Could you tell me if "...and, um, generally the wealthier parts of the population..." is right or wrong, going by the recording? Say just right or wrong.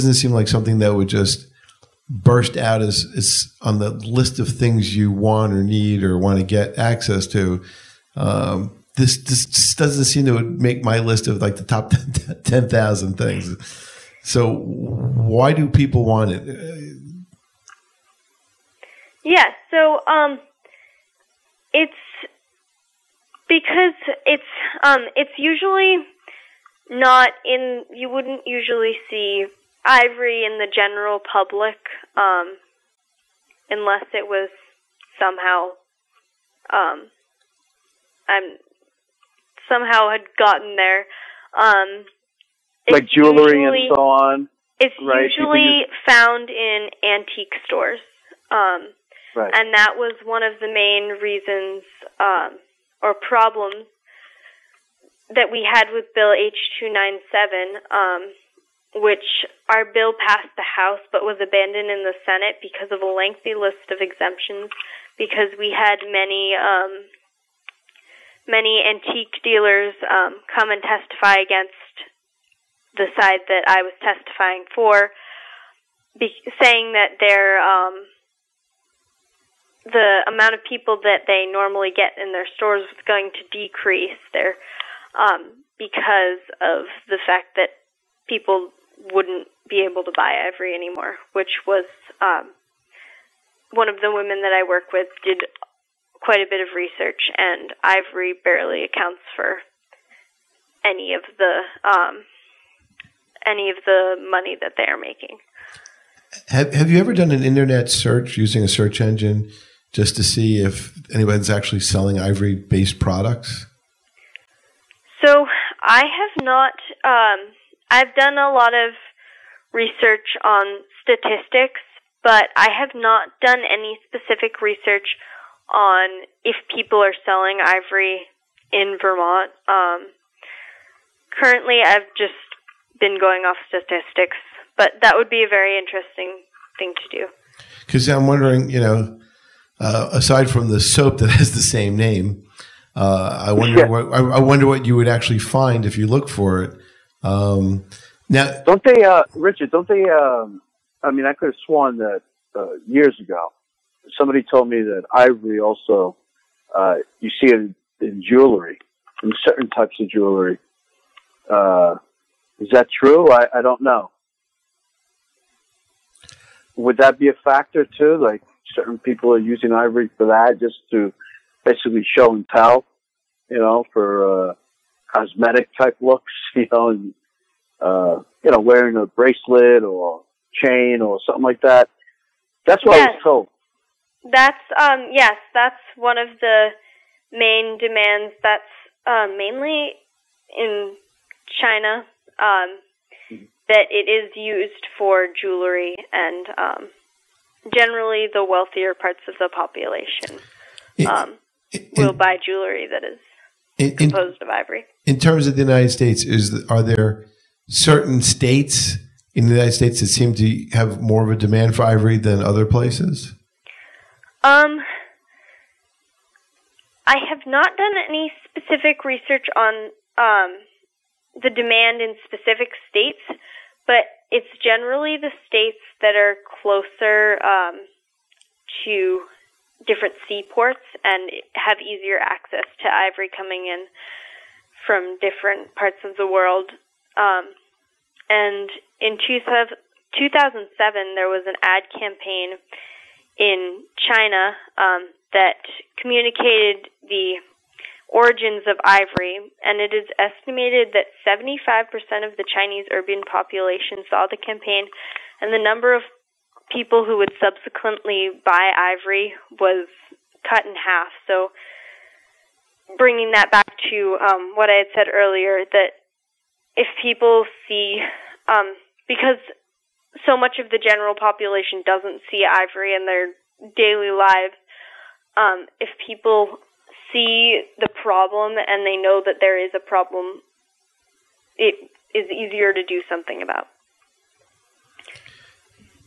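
right.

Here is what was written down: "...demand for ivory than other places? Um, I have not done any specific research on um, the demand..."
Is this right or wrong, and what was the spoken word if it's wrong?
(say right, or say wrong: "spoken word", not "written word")
right.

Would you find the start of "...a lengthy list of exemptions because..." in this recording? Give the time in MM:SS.
01:03.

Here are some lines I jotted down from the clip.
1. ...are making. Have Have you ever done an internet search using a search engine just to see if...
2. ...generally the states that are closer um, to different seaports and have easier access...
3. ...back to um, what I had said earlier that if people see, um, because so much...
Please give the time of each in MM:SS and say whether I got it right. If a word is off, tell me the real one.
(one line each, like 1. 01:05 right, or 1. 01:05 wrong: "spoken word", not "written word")
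1. 01:44 right
2. 03:44 right
3. 04:23 right.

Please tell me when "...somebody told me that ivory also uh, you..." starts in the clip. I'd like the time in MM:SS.
02:34.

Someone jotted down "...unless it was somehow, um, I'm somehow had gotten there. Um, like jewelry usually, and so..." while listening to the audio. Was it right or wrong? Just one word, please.
right.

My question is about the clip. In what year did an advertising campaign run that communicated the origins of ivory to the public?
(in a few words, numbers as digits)
2007.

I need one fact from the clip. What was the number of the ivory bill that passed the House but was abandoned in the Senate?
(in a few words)
H297.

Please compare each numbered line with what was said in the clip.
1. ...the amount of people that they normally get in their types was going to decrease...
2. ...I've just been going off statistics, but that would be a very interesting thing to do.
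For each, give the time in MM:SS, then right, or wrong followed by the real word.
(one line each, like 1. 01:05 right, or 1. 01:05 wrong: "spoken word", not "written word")
1. 01:19 wrong: "stores", not "types"
2. 02:11 right.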